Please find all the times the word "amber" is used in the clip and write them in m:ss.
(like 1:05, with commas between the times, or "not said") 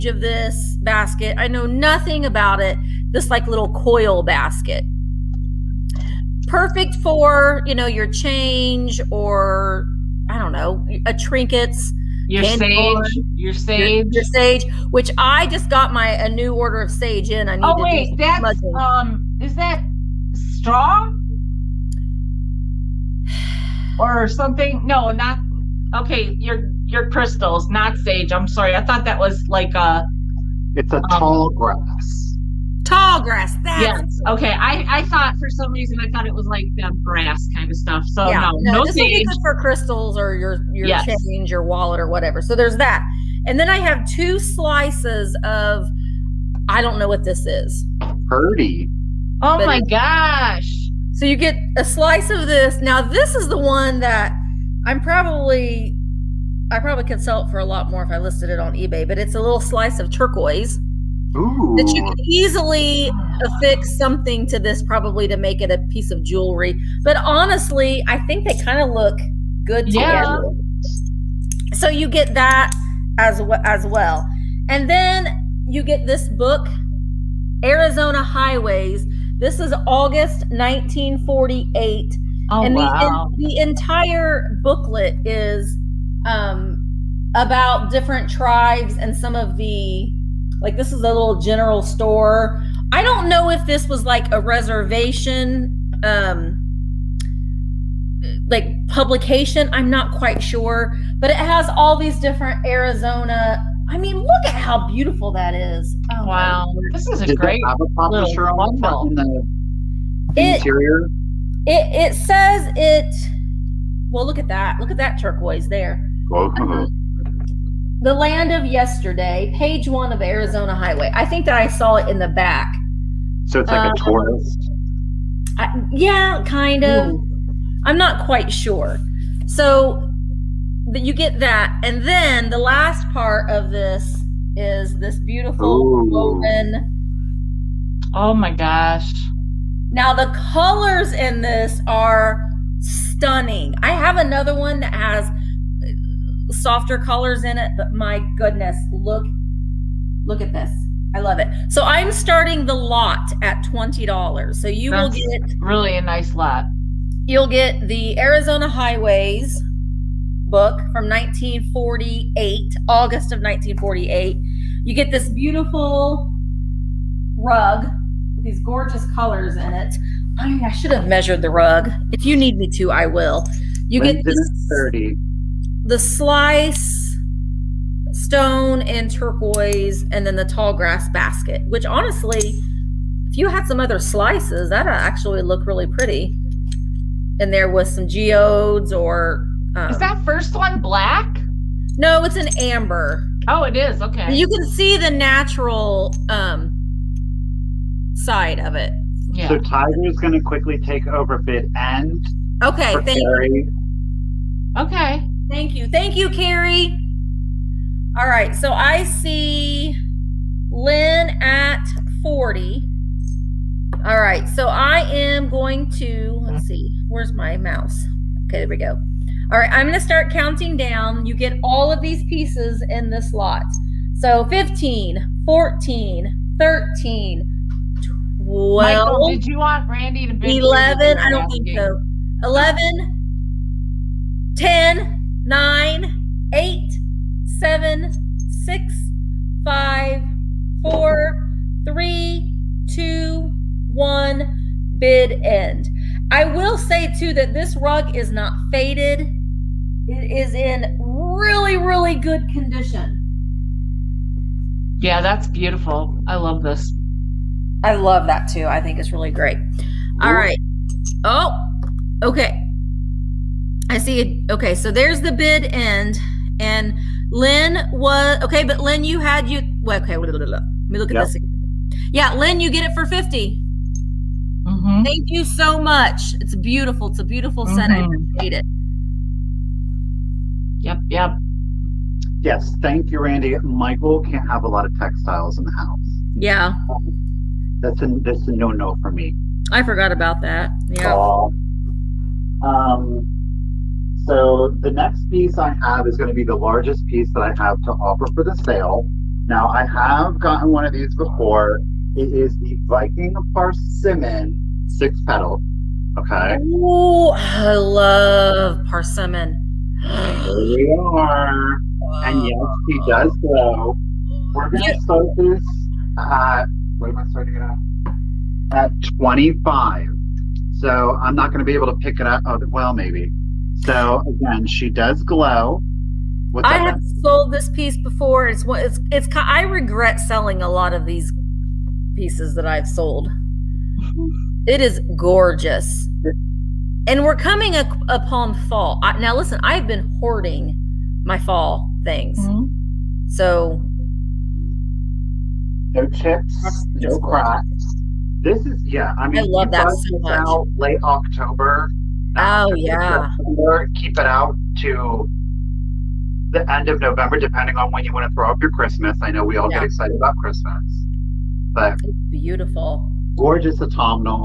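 3:12.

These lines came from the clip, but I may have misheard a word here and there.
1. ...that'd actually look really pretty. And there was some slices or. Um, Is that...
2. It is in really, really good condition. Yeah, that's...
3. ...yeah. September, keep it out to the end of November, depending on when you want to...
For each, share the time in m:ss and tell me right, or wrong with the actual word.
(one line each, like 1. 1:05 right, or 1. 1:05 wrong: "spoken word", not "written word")
1. 3:04 wrong: "geodes", not "slices"
2. 4:10 right
3. 5:52 right.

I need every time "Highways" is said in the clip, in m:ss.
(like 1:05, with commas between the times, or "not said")
1:18, 2:00, 2:38.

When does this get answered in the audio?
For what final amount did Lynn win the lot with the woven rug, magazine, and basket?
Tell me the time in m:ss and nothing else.
4:33.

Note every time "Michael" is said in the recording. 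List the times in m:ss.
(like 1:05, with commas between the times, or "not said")
3:48, 4:43.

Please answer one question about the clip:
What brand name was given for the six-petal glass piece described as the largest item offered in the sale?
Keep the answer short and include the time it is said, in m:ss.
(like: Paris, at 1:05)
Viking, at 5:02.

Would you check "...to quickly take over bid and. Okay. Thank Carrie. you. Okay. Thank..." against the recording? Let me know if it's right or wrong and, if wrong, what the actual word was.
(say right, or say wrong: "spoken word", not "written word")
right.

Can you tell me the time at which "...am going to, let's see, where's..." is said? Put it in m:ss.
3:35.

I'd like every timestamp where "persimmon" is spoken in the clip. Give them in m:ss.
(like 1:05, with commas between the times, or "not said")
5:03, 5:08.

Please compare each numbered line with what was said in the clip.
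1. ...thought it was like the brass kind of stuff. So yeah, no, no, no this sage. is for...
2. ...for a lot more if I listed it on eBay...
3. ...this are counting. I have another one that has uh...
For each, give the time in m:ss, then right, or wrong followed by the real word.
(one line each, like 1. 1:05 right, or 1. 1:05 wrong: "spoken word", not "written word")
1. 0:36 right
2. 0:57 right
3. 2:21 wrong: "stunning", not "counting".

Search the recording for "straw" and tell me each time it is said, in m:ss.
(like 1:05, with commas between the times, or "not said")
0:20.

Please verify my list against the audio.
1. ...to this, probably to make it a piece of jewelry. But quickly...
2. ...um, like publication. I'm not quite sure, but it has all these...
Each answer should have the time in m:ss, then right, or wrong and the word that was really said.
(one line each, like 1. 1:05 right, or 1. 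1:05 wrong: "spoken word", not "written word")
1. 1:04 wrong: "honestly", not "quickly"
2. 1:36 right.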